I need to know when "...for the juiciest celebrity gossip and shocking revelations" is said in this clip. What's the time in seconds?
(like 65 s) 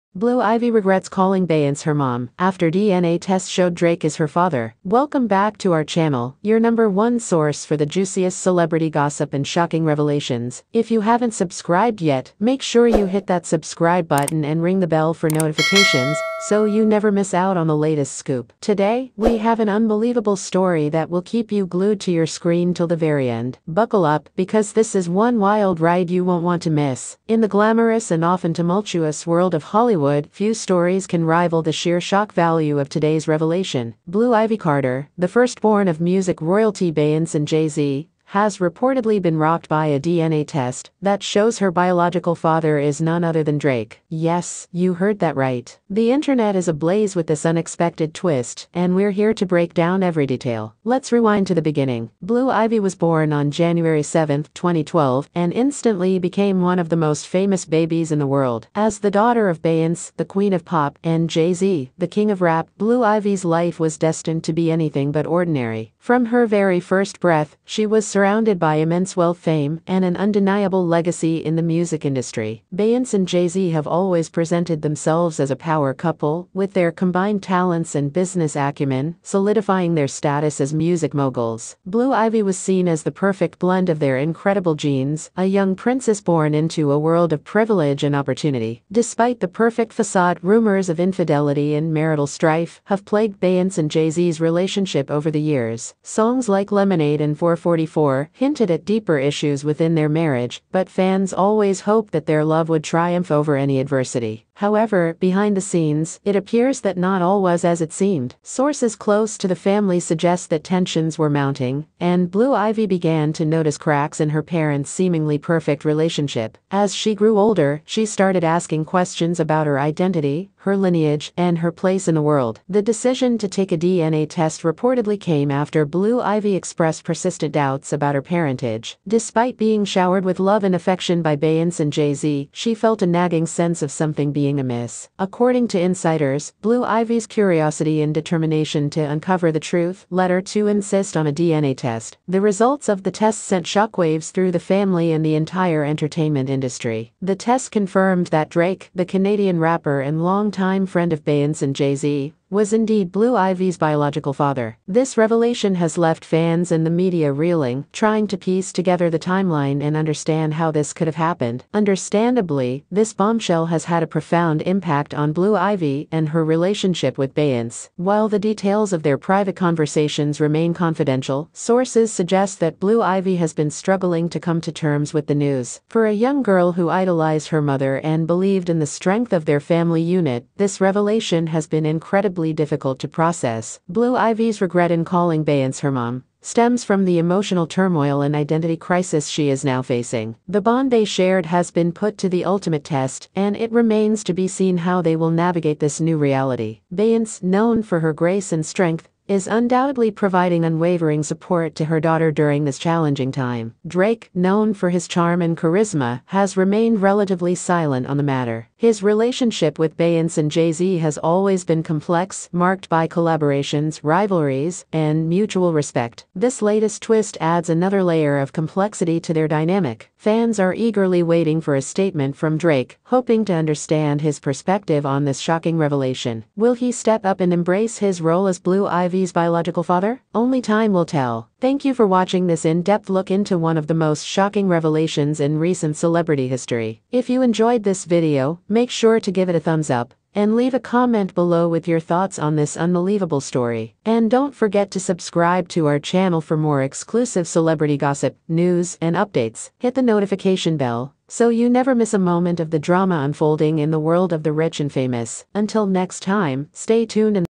7 s.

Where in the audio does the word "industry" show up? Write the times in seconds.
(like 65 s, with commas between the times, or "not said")
72 s, 146 s.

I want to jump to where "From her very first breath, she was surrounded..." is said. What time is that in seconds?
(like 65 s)
65 s.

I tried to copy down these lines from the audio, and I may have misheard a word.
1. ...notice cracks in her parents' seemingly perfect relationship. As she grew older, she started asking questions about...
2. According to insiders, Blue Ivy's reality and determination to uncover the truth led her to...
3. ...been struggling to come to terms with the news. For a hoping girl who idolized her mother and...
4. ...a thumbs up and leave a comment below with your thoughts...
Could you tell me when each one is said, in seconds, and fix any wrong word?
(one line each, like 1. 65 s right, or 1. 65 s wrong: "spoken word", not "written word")
1. 113 s right
2. 135 s wrong: "curiosity", not "reality"
3. 173 s wrong: "young", not "hoping"
4. 239 s right.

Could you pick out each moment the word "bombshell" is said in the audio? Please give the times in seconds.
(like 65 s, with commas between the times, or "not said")
163 s.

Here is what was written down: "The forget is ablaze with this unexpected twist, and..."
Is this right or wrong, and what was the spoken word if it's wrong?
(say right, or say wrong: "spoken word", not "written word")
wrong: "internet", not "forget".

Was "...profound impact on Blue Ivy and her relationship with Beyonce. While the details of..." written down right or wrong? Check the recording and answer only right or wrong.
right.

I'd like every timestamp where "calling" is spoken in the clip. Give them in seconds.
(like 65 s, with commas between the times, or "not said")
1 s, 185 s.